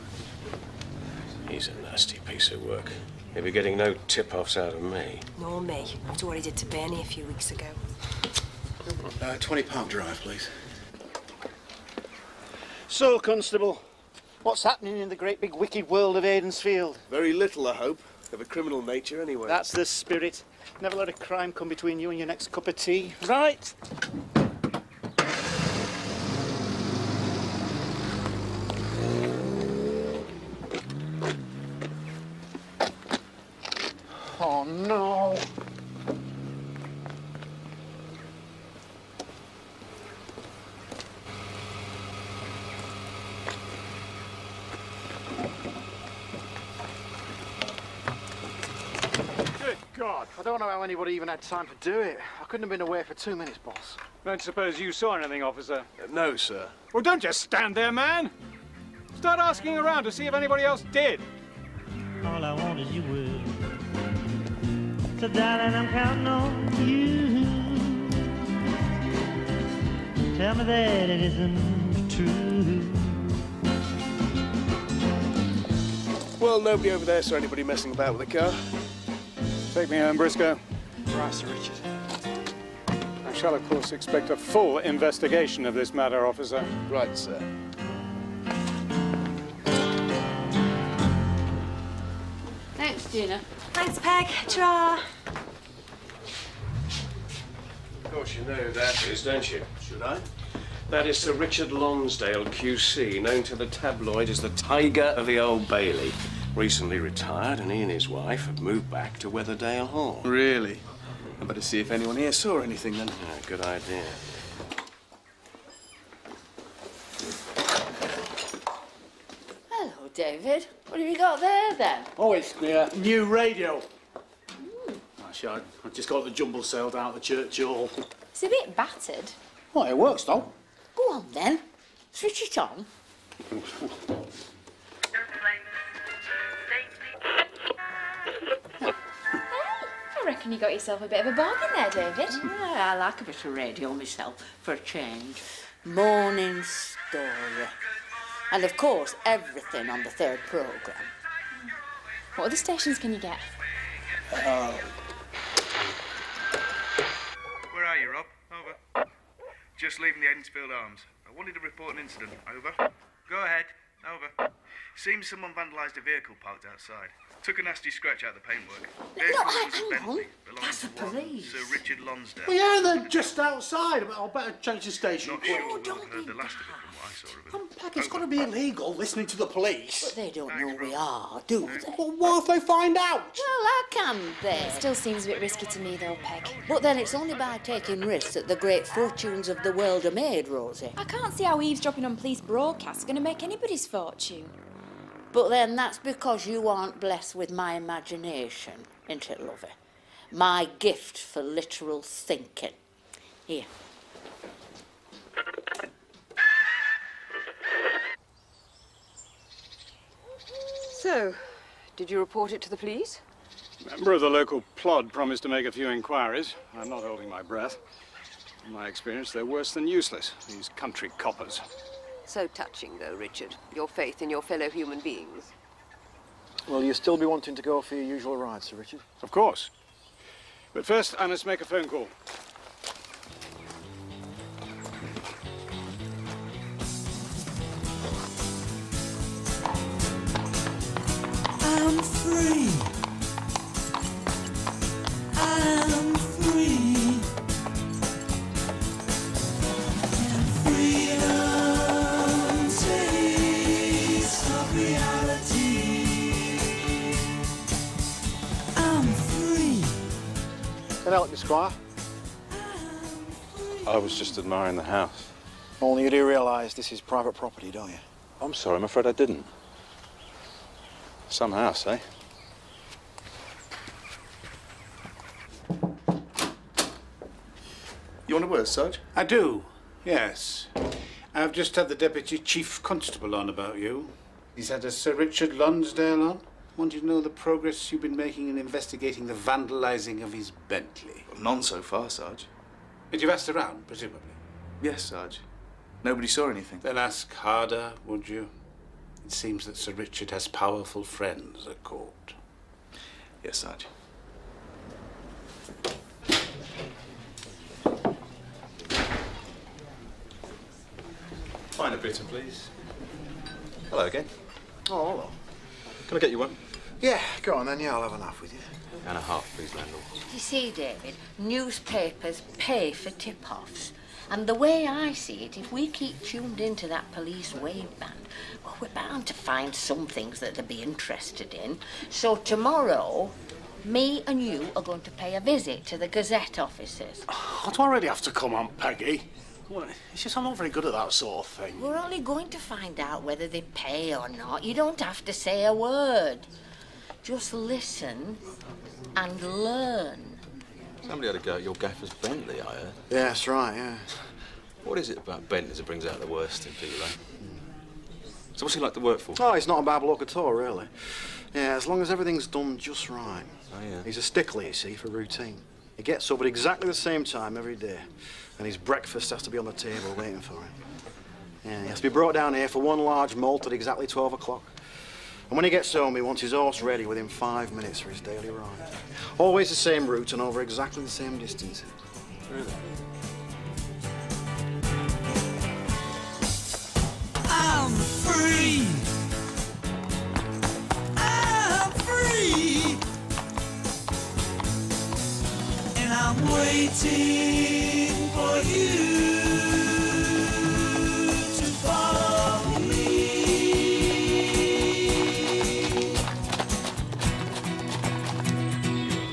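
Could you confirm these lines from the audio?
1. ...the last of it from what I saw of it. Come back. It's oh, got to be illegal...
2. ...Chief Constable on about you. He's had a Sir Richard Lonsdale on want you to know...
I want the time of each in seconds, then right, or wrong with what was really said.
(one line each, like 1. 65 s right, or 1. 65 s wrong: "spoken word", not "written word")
1. 176 s right
2. 282 s right.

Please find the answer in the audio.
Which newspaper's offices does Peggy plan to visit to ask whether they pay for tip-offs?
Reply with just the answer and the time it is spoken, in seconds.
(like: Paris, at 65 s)
The Gazette, at 336 s.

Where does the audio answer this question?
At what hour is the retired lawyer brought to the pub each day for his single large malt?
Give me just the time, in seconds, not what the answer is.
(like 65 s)
374 s.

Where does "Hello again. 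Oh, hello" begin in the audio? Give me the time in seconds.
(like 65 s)
313 s.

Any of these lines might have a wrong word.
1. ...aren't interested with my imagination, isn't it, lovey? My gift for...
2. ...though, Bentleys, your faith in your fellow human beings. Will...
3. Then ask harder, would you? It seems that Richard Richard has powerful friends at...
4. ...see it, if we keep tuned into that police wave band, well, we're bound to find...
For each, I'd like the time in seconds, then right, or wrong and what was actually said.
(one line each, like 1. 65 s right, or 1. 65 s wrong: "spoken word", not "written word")
1. 196 s wrong: "blessed", not "interested"
2. 222 s wrong: "Richard", not "Bentleys"
3. 296 s wrong: "Sir", not "Richard"
4. 325 s right.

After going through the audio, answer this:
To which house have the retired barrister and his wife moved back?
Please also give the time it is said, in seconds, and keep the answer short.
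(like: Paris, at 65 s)
Weatherdale Hall, at 109 s.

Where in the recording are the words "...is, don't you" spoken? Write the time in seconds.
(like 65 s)
99 s.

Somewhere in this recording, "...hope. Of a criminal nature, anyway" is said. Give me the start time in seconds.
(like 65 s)
17 s.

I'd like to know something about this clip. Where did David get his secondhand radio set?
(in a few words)
The jumble sale.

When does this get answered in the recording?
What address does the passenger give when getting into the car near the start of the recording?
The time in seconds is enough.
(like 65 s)
9 s.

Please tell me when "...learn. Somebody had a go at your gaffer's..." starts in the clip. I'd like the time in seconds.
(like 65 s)
349 s.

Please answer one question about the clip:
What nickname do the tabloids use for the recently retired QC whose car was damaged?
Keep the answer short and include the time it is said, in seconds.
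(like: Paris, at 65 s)
Tiger of the Old Bailey, at 104 s.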